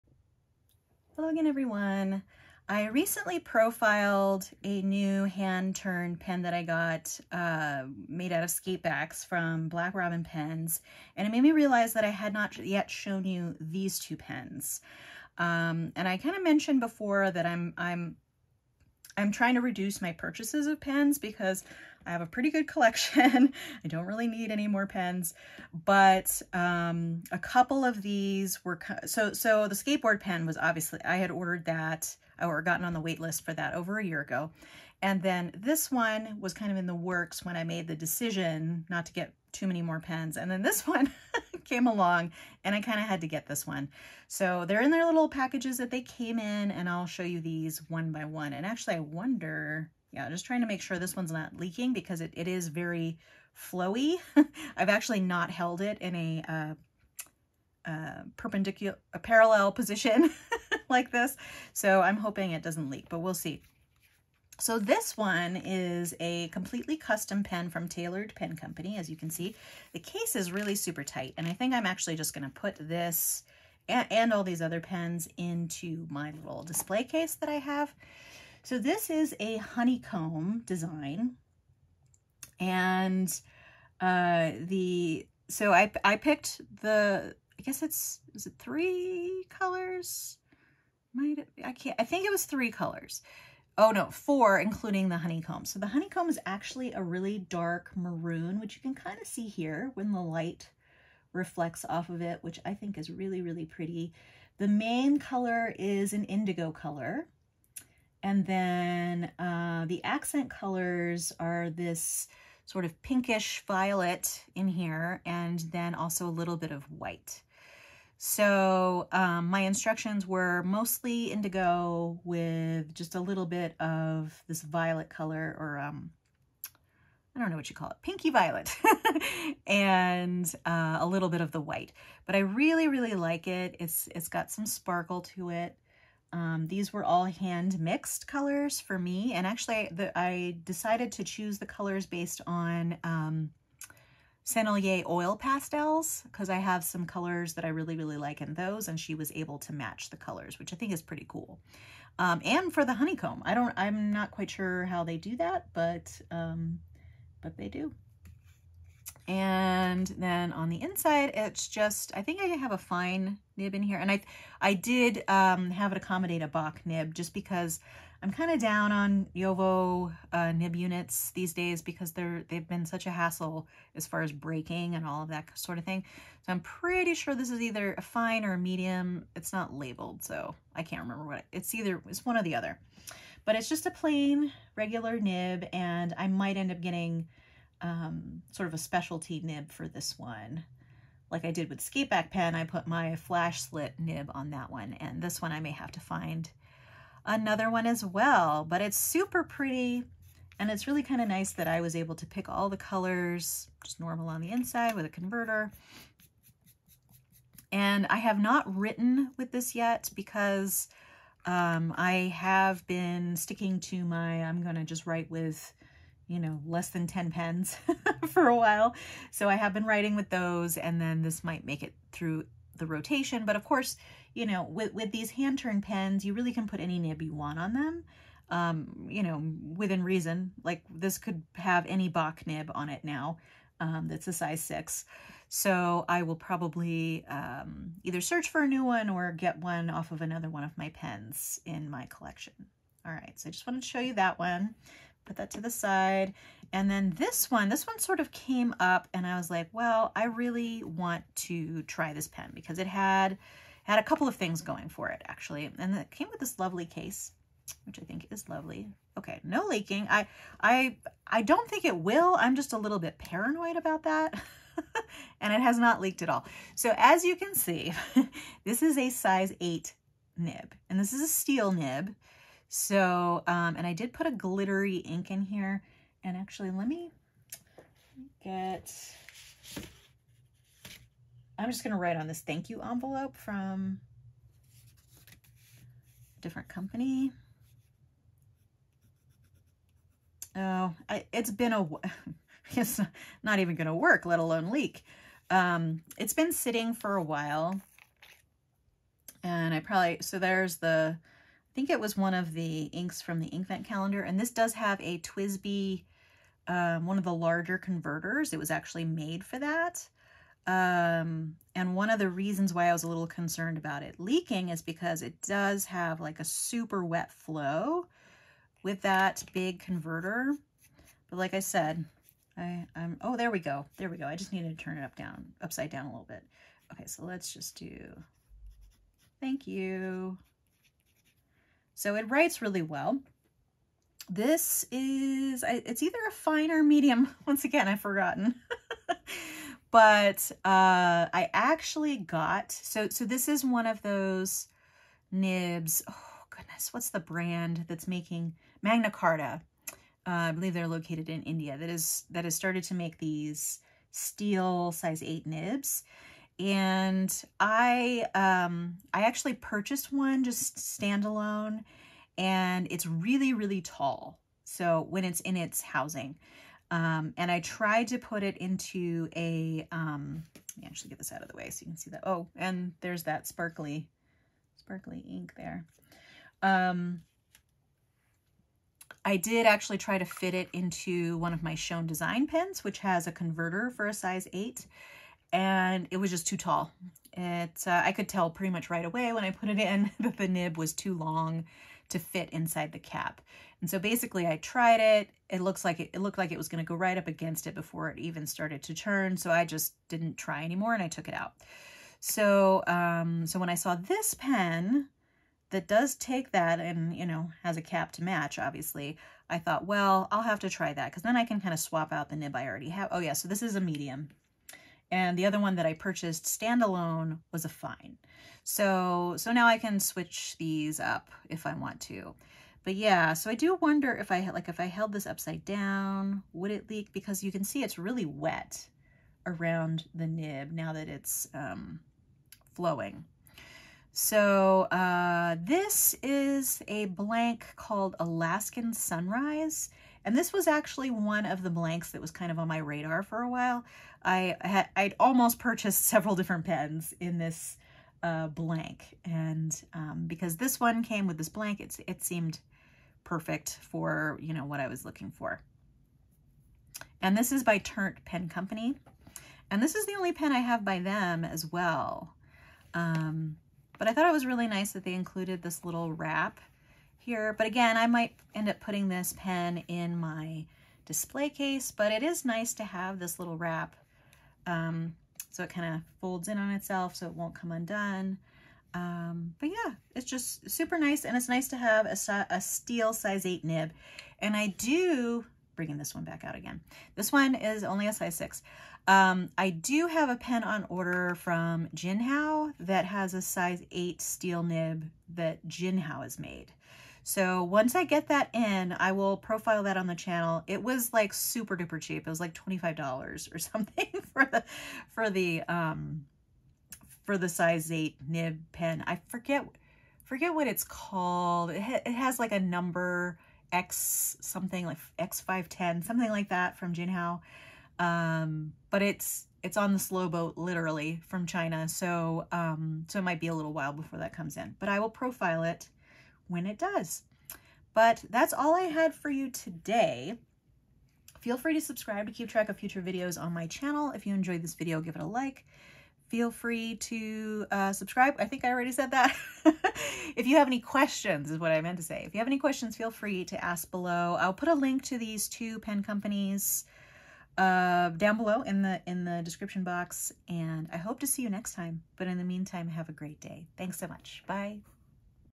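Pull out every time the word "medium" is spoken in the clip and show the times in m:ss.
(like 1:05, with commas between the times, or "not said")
2:58, 5:36, 6:53.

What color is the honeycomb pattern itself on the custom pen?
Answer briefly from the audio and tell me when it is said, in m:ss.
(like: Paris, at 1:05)
dark maroon, at 1:37.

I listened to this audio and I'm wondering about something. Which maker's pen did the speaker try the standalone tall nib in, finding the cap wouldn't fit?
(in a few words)
Schon DSGN.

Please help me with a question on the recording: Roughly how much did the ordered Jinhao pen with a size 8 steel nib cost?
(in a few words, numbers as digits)
$25.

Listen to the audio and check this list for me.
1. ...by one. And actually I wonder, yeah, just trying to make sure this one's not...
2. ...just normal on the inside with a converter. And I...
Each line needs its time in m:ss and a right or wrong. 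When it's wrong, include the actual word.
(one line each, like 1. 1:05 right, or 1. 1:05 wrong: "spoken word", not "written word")
1. 0:48 right
2. 3:23 right.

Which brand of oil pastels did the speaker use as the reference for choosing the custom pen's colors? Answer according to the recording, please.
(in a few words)
Sennelier.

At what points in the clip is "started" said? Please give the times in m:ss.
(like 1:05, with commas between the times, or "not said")
5:52, 6:38.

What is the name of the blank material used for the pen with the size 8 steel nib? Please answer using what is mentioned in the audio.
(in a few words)
Alaskan Sunrise.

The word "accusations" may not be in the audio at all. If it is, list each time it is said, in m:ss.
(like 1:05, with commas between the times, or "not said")
not said.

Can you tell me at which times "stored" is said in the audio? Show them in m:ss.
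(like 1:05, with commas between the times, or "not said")
not said.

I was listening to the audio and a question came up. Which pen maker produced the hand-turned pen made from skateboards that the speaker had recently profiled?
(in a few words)
Black Robin Pens.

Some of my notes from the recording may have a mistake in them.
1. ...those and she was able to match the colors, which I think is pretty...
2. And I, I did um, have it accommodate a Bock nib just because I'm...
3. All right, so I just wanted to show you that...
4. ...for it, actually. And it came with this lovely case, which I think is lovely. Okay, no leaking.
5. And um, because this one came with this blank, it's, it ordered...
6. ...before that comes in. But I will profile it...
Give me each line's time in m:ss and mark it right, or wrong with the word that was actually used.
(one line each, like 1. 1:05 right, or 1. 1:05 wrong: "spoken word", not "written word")
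1. 2:28 right
2. 2:43 right
3. 4:03 right
4. 4:14 right
5. 7:29 wrong: "seemed", not "ordered"
6. 8:43 right.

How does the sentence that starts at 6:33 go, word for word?
And so basically I tried it.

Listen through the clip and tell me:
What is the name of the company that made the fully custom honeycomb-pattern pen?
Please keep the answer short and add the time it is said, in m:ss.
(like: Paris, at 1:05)
Tailored Pen Company, at 1:07.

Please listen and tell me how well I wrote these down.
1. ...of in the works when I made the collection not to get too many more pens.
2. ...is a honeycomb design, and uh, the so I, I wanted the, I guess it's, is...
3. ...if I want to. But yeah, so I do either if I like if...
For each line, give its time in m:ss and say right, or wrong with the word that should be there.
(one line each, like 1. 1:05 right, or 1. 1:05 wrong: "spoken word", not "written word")
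1. 0:36 wrong: "decision", not "collection"
2. 1:19 wrong: "picked", not "wanted"
3. 7:01 wrong: "wonder", not "either".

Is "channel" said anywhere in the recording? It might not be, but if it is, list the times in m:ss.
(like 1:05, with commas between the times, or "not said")
8:20, 8:53.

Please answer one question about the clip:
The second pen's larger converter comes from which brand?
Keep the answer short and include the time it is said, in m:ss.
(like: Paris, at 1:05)
TWSBI, at 5:05.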